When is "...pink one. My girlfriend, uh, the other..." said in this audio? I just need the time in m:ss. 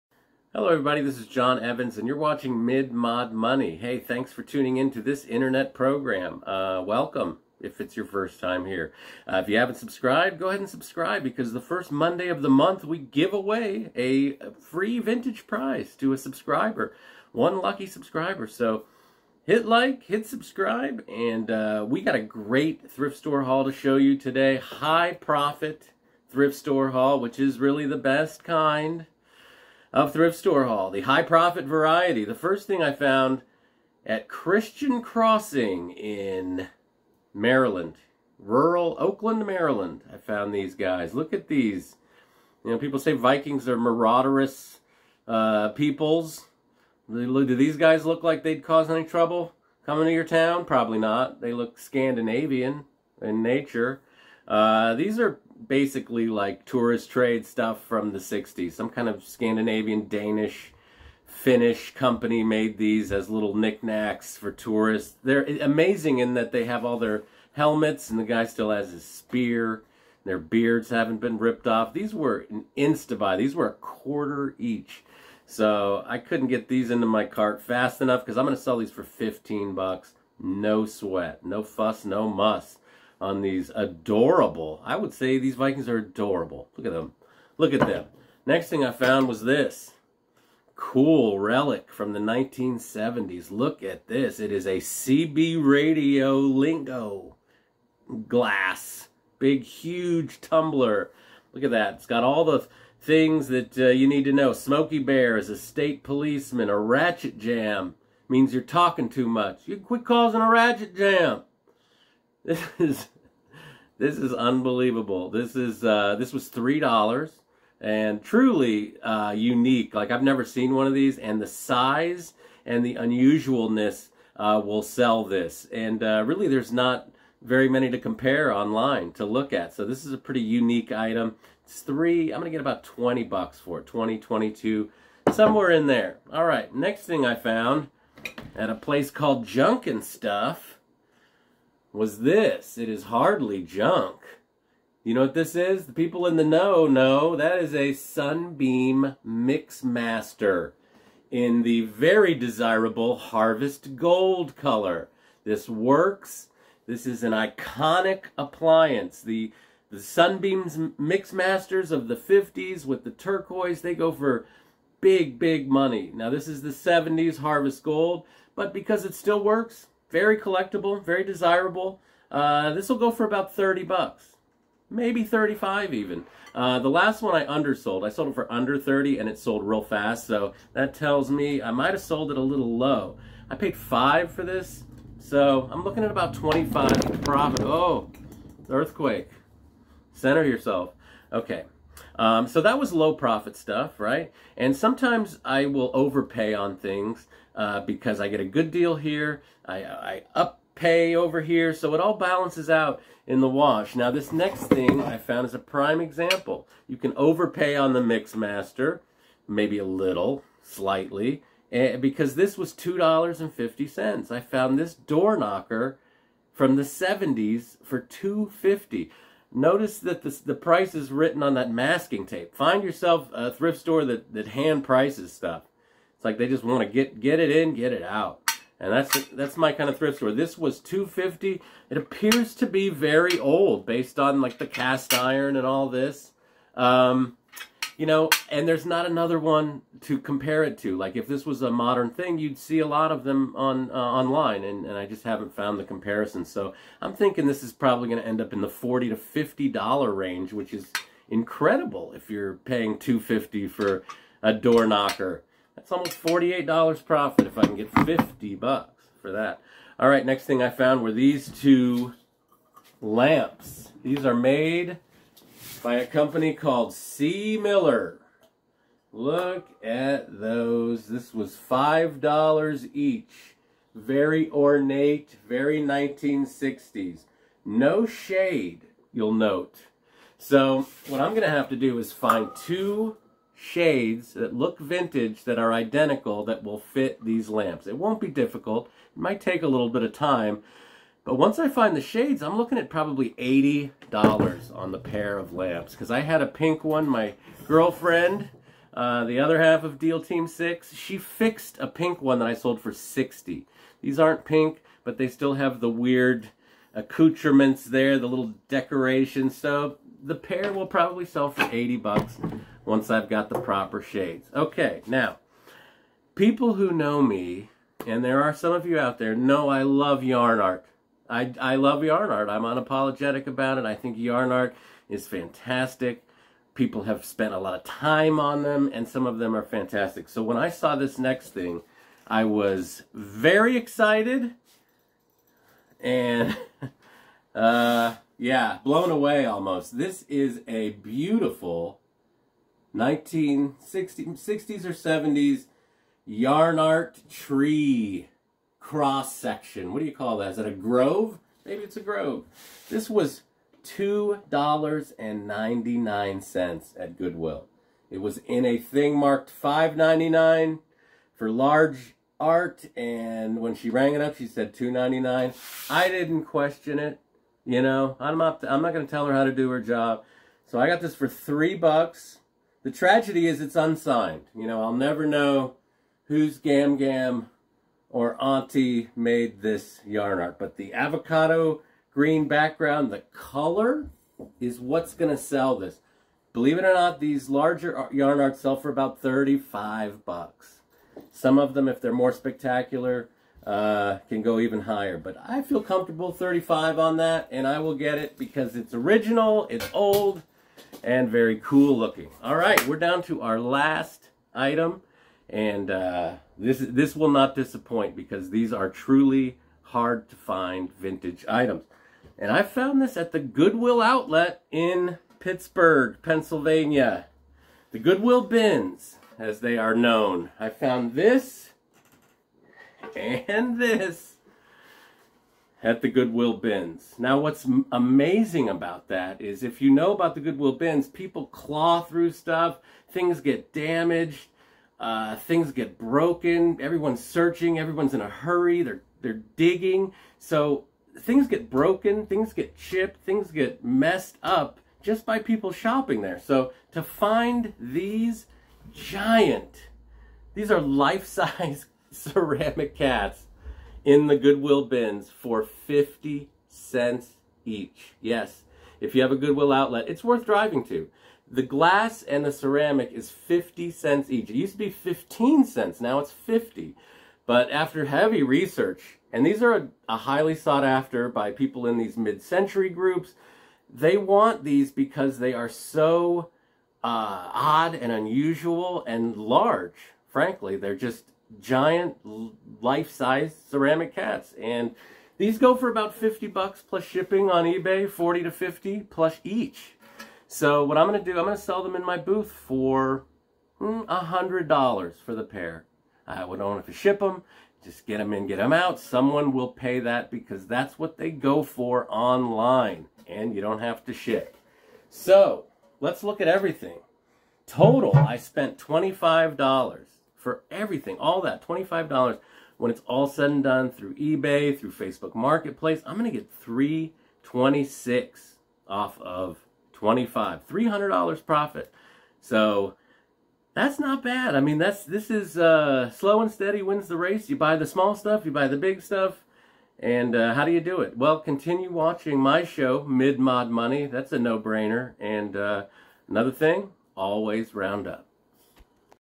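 4:56.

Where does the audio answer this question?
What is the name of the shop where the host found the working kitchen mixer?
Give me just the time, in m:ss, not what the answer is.
2:19.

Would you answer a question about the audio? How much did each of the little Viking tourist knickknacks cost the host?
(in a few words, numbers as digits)
a quarter.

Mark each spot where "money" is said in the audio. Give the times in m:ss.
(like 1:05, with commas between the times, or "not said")
0:03, 2:45, 8:53.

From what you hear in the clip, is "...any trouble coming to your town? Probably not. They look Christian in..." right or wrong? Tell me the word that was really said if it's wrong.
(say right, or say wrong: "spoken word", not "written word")
wrong: "Scandinavian", not "Christian".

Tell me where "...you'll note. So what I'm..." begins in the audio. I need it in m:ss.
4:39.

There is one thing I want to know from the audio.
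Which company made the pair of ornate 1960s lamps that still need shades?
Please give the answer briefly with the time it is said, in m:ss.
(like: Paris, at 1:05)
C. Miller, at 4:26.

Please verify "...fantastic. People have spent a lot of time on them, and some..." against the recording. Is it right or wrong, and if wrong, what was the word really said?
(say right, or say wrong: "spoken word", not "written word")
right.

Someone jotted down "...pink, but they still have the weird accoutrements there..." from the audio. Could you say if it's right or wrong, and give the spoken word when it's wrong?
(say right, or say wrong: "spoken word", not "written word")
right.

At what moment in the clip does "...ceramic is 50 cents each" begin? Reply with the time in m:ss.
7:42.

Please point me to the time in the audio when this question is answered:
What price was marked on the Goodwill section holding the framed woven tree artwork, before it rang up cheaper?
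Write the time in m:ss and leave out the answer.
5:59.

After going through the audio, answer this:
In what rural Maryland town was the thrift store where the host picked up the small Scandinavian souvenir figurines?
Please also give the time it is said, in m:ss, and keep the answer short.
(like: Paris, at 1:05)
Oakland, at 0:38.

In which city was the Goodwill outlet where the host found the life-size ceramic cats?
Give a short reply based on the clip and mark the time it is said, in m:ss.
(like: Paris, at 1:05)
Pittsburgh, at 6:55.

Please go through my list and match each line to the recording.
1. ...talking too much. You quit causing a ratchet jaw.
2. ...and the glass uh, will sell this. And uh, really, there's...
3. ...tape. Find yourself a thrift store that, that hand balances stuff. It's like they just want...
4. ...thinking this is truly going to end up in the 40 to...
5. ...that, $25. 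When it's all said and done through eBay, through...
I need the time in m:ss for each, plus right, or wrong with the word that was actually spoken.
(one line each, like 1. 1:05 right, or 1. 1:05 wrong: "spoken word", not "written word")
1. 1:48 right
2. 2:02 wrong: "unusualness", not "glass"
3. 3:42 wrong: "prices", not "balances"
4. 4:07 wrong: "probably", not "truly"
5. 8:31 right.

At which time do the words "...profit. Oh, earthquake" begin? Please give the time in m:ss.
3:07.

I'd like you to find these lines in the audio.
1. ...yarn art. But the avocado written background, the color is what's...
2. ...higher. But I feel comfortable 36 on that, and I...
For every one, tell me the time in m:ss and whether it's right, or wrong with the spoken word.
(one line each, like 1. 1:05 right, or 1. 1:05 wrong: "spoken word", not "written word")
1. 6:20 wrong: "green", not "written"
2. 6:34 wrong: "35", not "36".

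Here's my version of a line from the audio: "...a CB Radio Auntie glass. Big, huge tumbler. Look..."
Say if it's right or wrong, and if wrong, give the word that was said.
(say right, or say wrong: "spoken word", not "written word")
wrong: "Lingo", not "Auntie".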